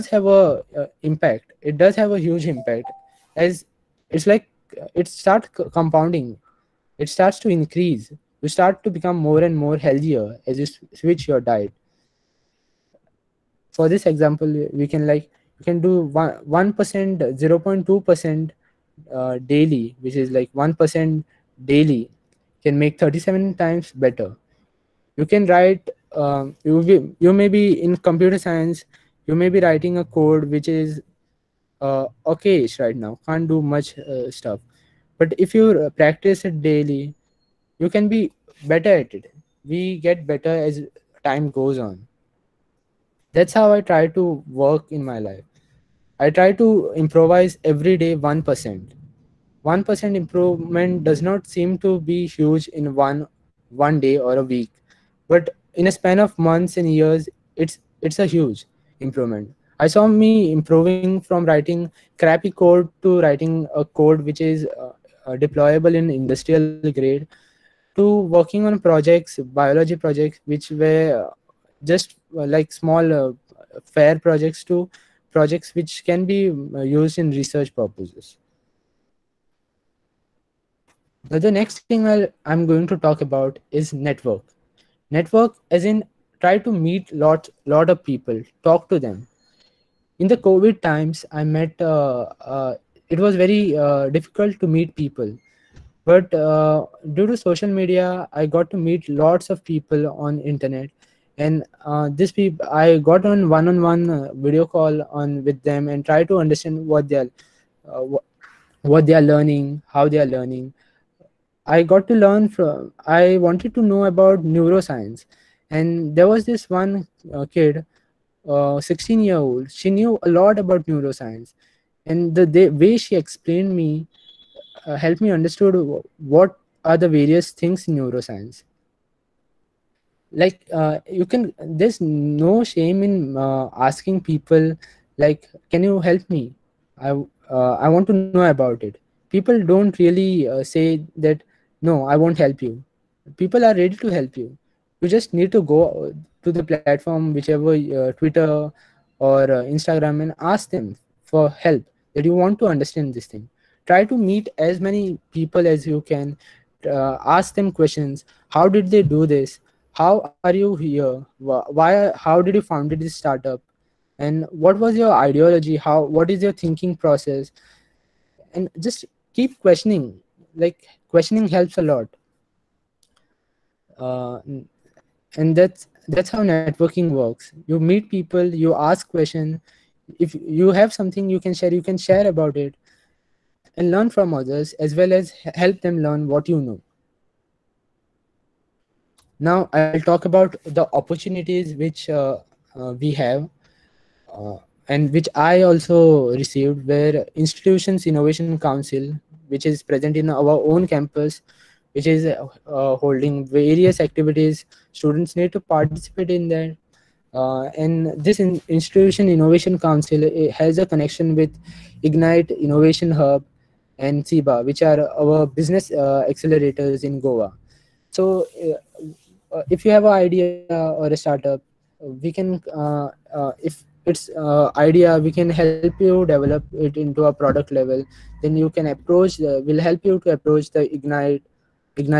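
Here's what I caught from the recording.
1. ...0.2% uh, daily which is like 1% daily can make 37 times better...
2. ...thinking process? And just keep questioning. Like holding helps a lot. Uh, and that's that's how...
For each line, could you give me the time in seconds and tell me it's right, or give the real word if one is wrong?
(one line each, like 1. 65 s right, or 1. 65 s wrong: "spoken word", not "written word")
1. 16 s right
2. 166 s wrong: "questioning", not "holding".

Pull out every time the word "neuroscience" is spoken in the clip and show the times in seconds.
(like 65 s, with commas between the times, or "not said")
114 s, 120 s, 127 s.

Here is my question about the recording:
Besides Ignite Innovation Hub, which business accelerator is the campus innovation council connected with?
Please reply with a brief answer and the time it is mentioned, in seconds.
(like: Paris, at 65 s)
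CIBA, at 214 s.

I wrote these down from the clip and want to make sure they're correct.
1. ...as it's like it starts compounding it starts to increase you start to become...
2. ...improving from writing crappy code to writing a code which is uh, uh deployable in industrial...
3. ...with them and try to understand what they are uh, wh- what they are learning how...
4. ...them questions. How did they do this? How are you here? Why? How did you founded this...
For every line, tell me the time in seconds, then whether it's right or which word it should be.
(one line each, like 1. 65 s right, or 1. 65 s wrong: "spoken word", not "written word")
1. 3 s right
2. 60 s right
3. 105 s right
4. 157 s right.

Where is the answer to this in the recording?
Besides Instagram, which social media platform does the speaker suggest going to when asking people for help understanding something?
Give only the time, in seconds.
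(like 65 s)
148 s.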